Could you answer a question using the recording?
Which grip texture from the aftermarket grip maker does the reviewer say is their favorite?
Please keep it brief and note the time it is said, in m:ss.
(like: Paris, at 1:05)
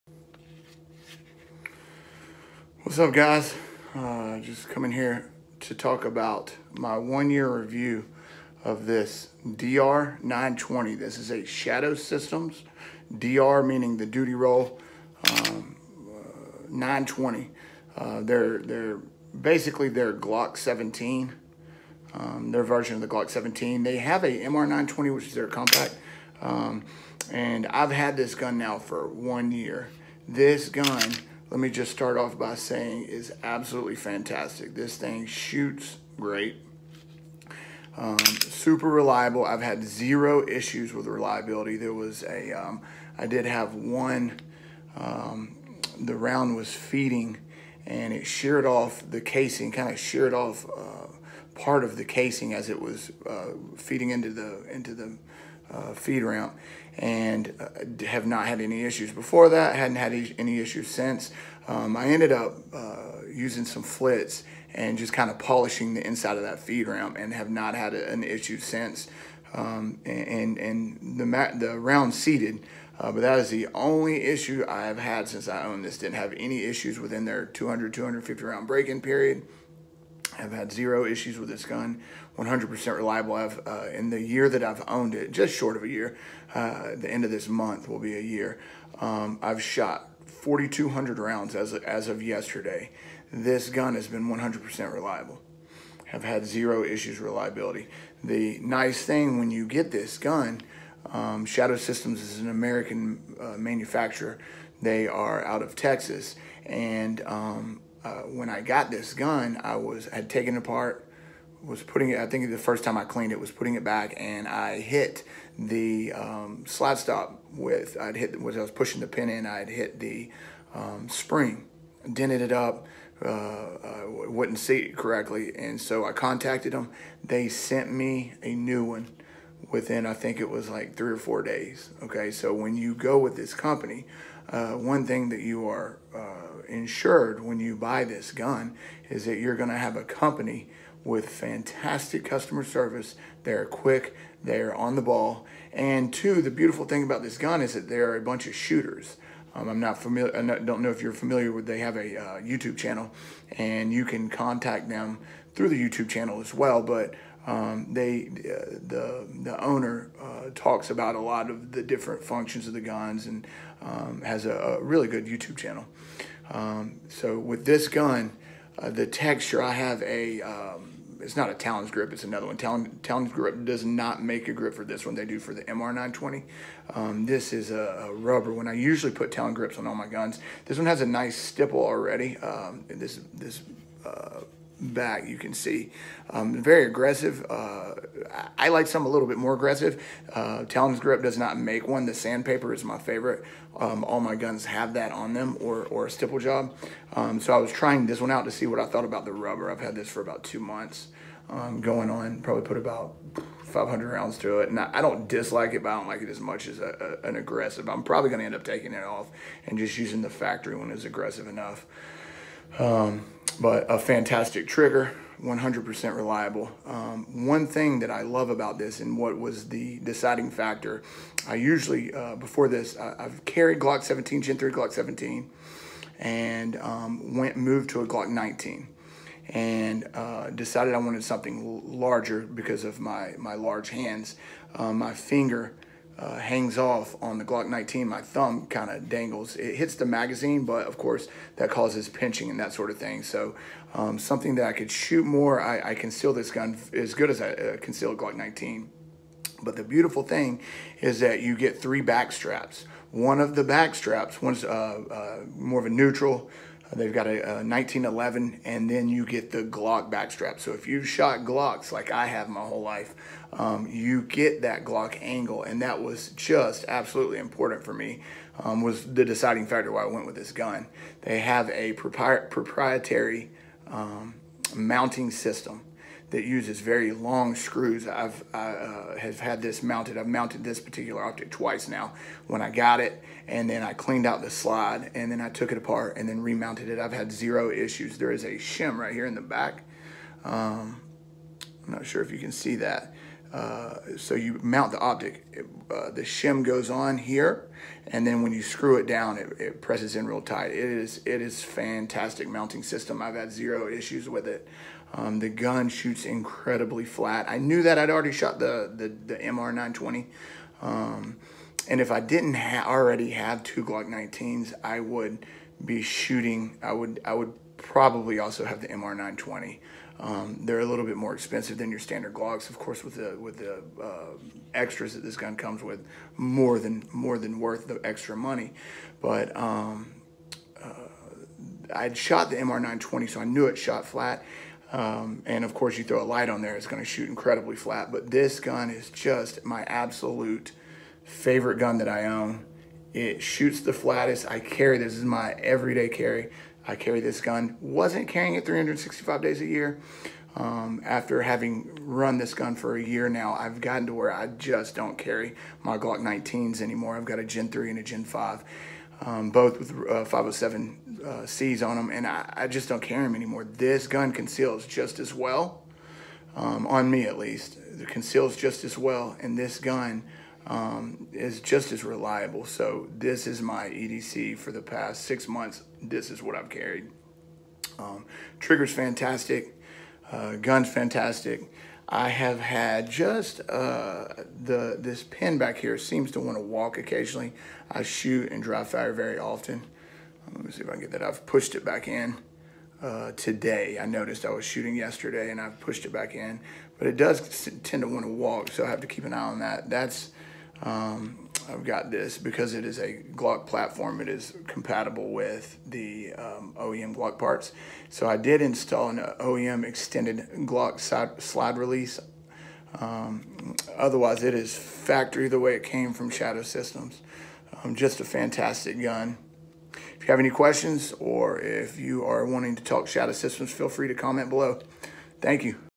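Sandpaper, at 3:12.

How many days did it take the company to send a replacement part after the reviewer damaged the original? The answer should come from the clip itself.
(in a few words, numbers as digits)
3 or 4 days.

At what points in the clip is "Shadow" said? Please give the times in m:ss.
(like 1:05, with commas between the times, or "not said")
0:11, 1:41, 6:56, 7:03.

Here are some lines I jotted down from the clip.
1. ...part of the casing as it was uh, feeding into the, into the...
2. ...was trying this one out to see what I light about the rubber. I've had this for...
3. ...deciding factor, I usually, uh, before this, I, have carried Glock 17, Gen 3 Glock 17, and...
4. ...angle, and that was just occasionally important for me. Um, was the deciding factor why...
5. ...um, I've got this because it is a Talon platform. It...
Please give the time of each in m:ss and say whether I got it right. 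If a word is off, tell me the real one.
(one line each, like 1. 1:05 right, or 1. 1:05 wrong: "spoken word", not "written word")
1. 0:51 right
2. 3:17 wrong: "thought", not "light"
3. 3:39 right
4. 4:25 wrong: "absolutely", not "occasionally"
5. 6:40 wrong: "Glock", not "Talon".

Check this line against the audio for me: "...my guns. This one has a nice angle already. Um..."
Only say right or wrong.
wrong.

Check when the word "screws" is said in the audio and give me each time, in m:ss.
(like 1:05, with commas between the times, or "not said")
4:37, 4:58.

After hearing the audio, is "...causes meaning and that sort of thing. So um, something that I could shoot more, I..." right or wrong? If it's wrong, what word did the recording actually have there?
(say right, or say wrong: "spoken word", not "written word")
wrong: "pinching", not "meaning".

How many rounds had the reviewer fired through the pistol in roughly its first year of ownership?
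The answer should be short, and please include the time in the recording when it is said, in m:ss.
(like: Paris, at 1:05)
4,200, at 1:30.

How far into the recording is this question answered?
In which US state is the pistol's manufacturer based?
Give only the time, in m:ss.
1:45.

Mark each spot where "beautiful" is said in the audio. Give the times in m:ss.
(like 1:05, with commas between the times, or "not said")
2:26, 4:09.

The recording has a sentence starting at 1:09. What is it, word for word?
Um, and, and the, the round seated, uh, but that is the only issue I have had since I owned this.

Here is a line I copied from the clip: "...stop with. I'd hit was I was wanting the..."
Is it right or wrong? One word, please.
wrong.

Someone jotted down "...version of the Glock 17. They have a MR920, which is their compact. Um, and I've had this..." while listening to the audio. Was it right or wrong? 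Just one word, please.
right.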